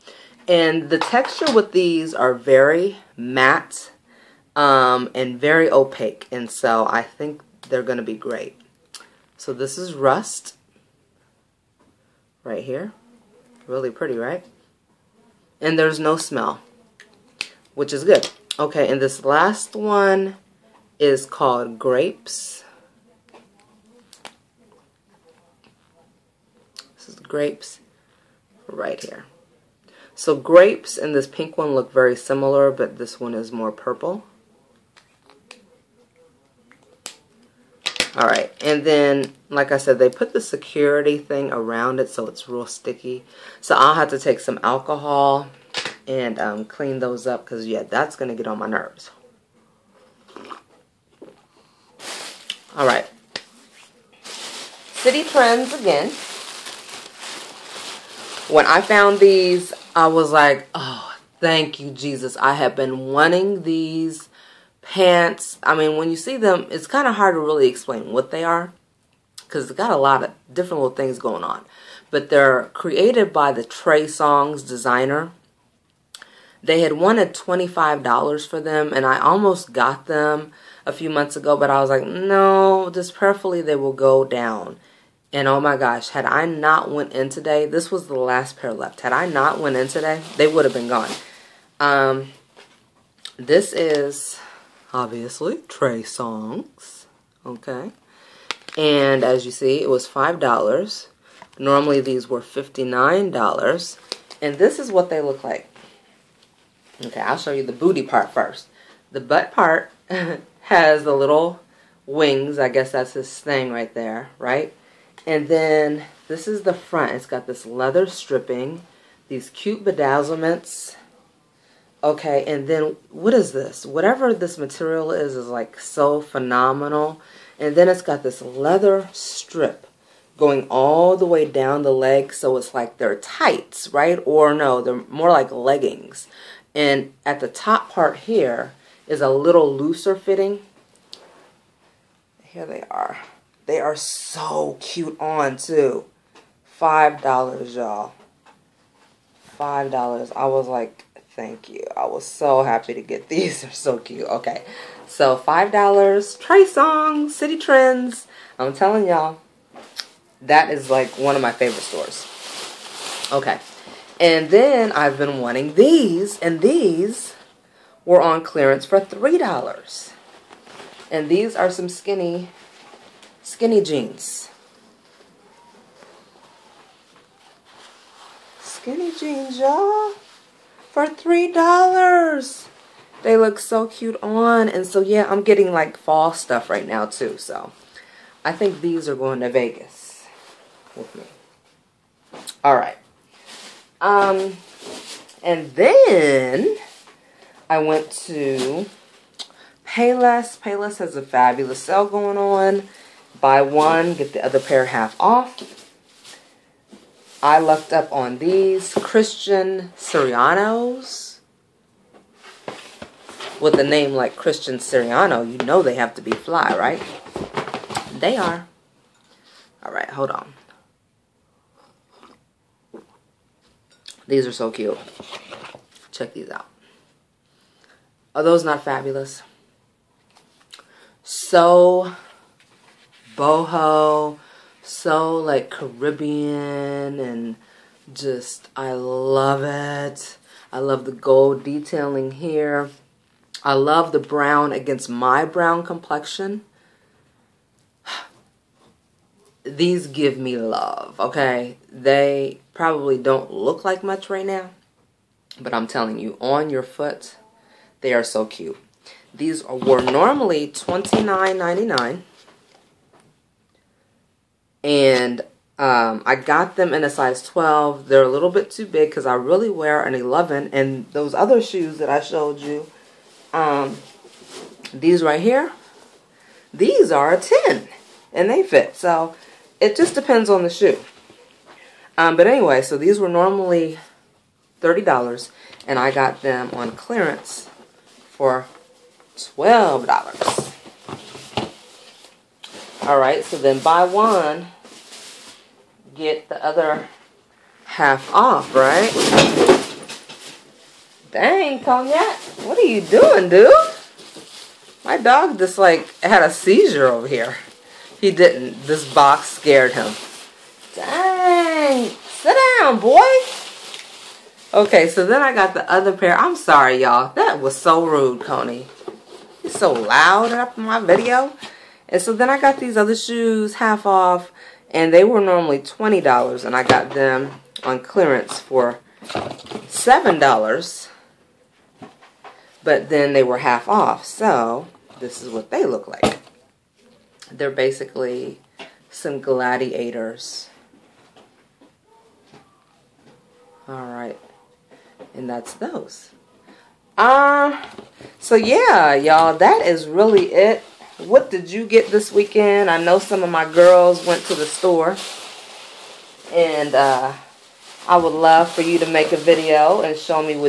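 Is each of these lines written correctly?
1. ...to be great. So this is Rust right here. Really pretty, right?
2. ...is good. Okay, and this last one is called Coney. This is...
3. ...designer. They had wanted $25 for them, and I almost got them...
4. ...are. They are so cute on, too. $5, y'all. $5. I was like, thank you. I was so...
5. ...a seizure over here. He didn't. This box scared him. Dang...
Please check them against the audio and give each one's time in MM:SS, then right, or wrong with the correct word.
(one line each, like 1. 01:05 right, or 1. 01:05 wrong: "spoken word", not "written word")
1. 00:07 right
2. 00:17 wrong: "Grapes", not "Coney"
3. 01:14 right
4. 02:22 right
5. 05:06 right.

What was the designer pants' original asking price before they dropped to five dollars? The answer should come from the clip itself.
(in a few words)
$59.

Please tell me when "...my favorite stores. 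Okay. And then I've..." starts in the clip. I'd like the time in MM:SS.
02:41.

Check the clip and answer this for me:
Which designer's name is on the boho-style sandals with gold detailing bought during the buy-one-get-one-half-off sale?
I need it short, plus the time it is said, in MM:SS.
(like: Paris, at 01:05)
Christian Siriano, at 03:28.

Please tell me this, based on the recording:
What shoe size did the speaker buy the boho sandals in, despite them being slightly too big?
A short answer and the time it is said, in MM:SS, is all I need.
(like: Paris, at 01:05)
12, at 04:27.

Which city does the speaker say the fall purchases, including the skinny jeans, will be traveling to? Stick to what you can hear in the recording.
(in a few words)
Vegas.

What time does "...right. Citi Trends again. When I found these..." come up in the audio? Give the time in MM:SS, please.
00:52.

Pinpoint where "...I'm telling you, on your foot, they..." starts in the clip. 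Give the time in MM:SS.
04:15.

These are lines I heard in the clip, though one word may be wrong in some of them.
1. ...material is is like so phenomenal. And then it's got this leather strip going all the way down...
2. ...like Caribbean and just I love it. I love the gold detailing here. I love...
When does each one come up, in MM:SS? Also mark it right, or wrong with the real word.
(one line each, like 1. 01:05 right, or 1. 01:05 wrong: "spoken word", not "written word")
1. 02:04 right
2. 03:55 right.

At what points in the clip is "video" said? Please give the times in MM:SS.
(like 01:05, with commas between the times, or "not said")
05:20, 05:59.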